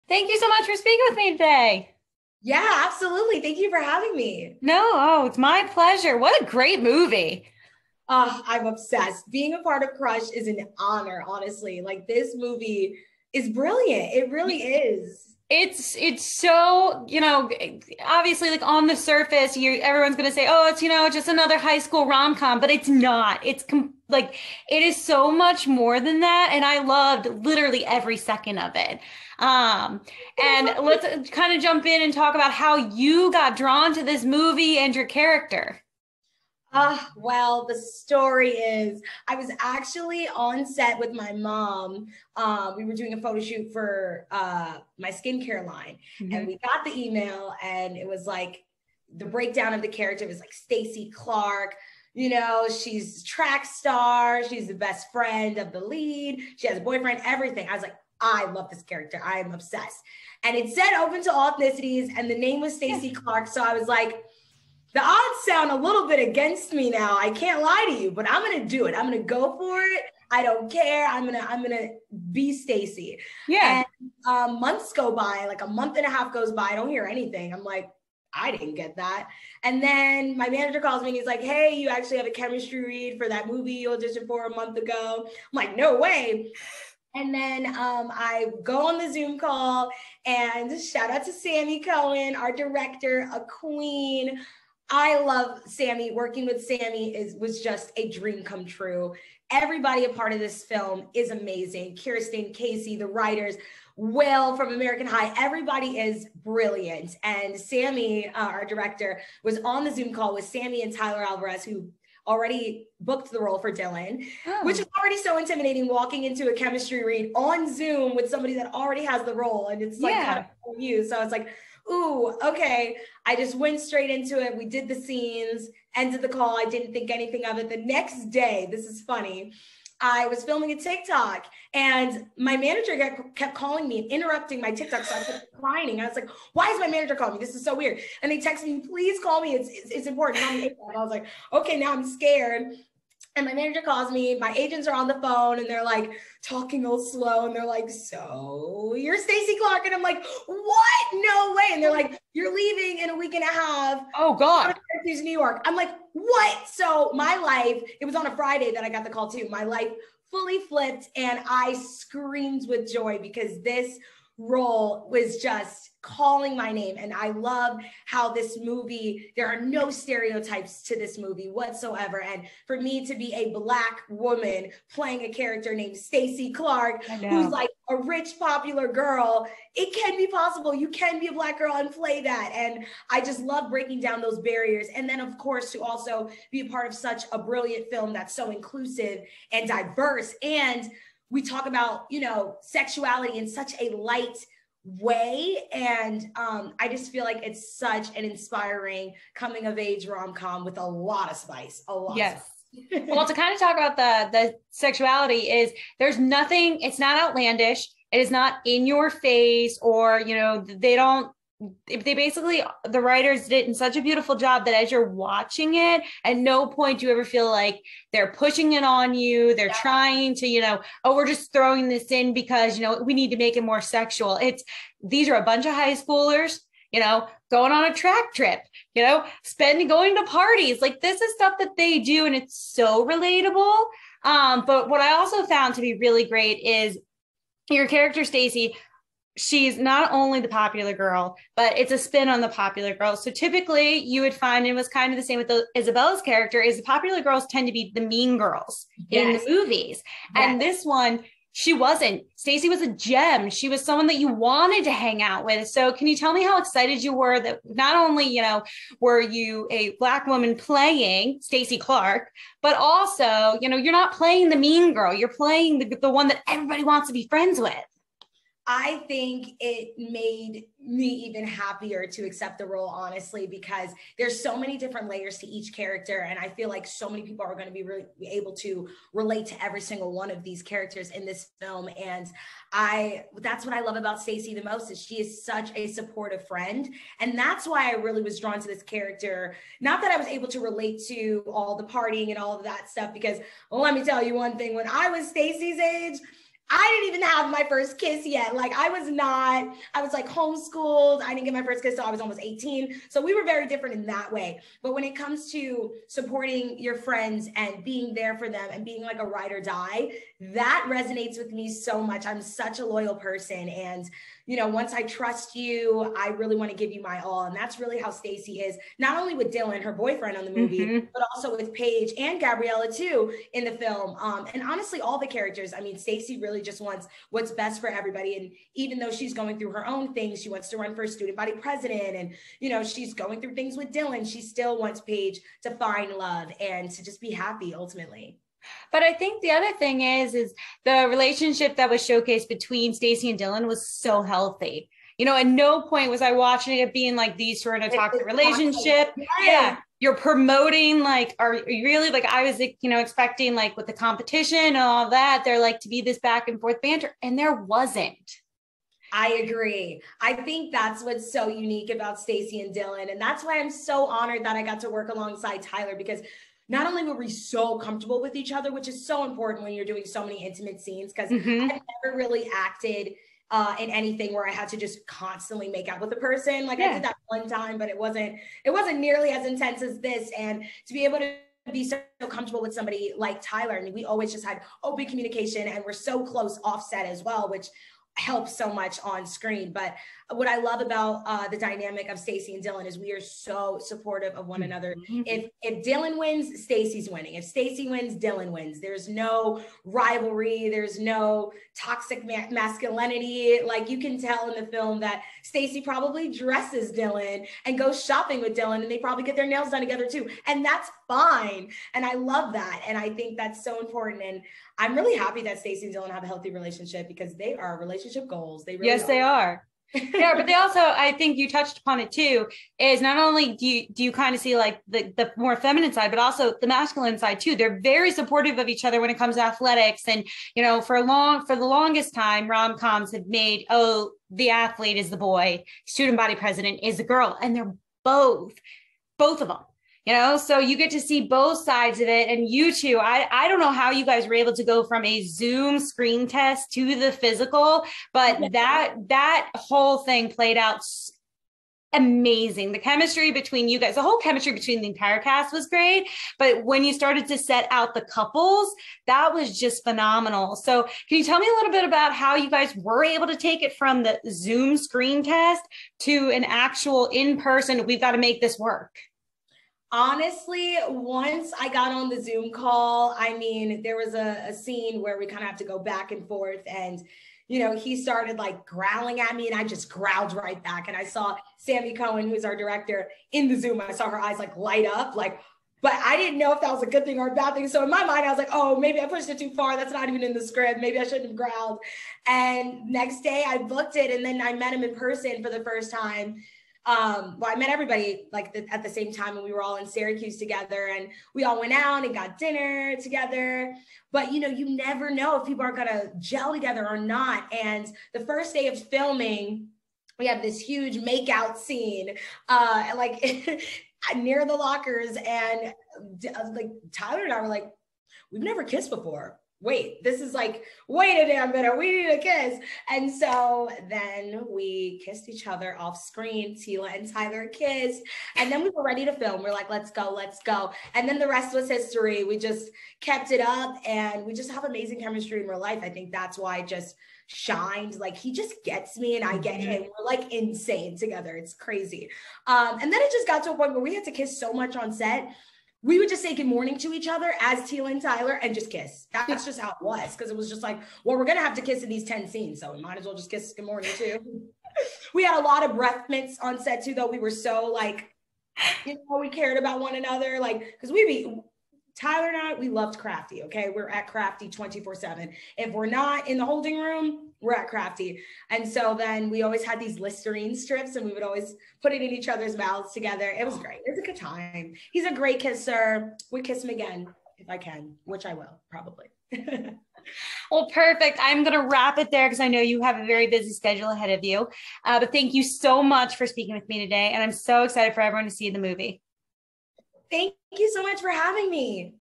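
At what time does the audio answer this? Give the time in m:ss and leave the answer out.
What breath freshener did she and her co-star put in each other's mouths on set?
9:29.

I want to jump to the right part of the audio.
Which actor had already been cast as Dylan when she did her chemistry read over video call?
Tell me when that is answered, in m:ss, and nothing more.
1:50.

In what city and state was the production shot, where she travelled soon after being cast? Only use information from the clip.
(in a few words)
Syracuse, New York.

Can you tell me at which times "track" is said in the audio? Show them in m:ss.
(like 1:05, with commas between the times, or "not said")
0:53, 3:47.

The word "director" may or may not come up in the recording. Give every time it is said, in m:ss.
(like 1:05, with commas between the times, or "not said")
1:32, 1:48, 8:02.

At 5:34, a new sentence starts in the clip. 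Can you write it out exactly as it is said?
She still wants Paige to find love and to just be happy ultimately.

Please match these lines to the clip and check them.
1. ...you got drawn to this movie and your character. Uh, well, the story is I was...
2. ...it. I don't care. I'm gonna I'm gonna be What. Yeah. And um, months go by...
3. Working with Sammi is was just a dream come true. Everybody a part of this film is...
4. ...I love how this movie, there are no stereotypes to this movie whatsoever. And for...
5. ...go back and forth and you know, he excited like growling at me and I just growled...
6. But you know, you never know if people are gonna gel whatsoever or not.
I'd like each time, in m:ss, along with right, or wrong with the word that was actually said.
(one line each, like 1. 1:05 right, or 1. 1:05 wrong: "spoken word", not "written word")
1. 0:32 right
2. 1:09 wrong: "Stacy", not "What"
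3. 1:36 right
4. 2:47 right
5. 7:55 wrong: "started", not "excited"
6. 8:24 wrong: "together", not "whatsoever".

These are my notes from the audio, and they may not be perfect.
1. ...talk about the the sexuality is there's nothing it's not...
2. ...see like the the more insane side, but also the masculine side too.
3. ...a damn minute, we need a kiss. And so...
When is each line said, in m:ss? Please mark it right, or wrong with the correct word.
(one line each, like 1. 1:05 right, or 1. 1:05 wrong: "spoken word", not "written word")
1. 3:23 right
2. 7:04 wrong: "feminine", not "insane"
3. 8:41 right.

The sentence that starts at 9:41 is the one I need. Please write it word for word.
I'm going to wrap it there because I know you have a very busy schedule ahead of you.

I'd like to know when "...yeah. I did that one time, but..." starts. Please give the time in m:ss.
6:16.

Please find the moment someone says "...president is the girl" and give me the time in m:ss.
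7:16.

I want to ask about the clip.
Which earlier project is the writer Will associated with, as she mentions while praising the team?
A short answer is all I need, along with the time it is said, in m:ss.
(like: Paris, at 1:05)
American High, at 1:44.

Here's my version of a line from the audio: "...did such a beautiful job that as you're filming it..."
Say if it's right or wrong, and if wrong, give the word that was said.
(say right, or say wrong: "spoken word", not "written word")
wrong: "watching", not "filming".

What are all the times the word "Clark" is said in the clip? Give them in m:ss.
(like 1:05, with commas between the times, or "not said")
0:51, 1:03, 2:29, 2:56, 4:21.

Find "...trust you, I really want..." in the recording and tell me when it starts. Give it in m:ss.
5:15.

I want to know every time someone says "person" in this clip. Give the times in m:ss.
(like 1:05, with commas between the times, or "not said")
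5:13, 6:16, 7:47, 8:14.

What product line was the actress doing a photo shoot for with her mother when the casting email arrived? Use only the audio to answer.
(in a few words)
Skincare line.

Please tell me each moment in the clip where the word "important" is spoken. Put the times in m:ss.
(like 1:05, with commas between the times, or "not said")
2:20, 6:09, 6:53.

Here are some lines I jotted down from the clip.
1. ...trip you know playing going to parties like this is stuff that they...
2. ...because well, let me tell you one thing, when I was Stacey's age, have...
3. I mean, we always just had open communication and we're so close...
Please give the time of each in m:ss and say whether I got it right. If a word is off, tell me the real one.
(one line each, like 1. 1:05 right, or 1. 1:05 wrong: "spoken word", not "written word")
1. 3:48 wrong: "spending", not "playing"
2. 4:53 right
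3. 6:23 right.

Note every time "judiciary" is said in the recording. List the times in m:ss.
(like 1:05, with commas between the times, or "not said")
not said.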